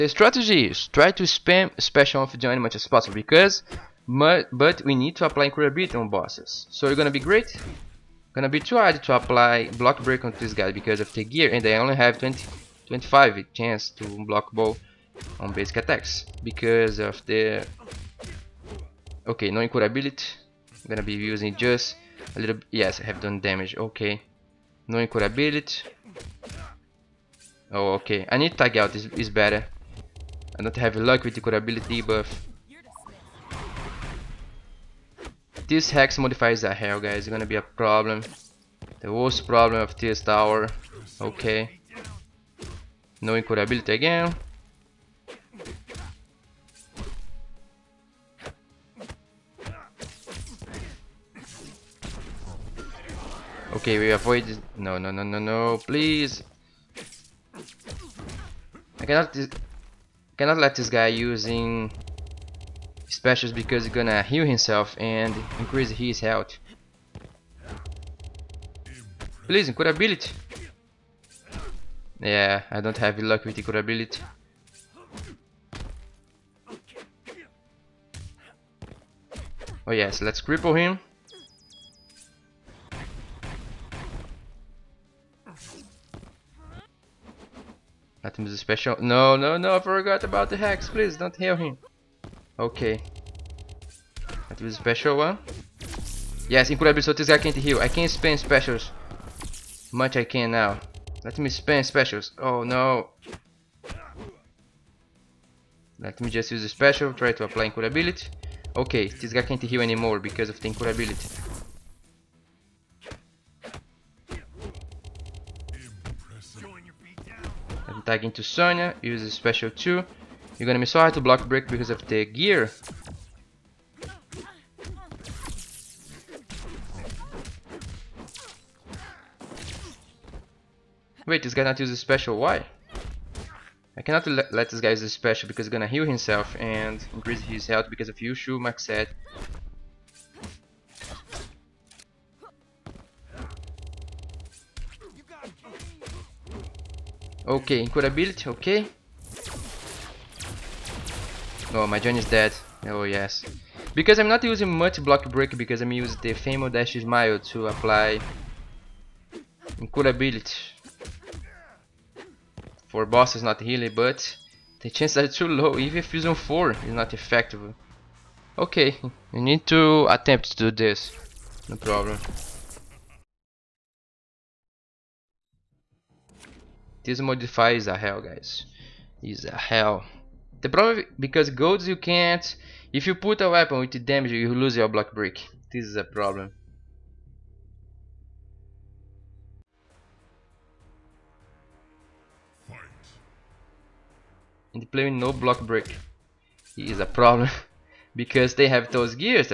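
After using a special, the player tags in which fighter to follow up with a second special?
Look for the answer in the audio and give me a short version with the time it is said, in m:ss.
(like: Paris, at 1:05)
Sonya, at 1:58.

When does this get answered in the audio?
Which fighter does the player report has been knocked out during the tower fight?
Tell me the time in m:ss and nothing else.
2:31.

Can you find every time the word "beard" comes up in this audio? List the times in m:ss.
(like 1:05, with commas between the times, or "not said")
not said.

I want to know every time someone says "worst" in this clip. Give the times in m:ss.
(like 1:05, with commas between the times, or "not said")
0:39.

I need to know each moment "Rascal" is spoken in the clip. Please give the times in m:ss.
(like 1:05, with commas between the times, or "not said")
not said.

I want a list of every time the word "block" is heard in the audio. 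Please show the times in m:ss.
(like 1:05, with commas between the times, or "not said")
0:09, 0:14, 2:01, 2:35, 3:04, 3:15.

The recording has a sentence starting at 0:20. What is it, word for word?
I'm gonna be using just a little...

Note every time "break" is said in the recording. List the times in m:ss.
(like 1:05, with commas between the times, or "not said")
0:10, 2:01, 2:35, 3:05, 3:15.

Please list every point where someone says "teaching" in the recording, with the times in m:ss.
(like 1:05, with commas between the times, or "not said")
not said.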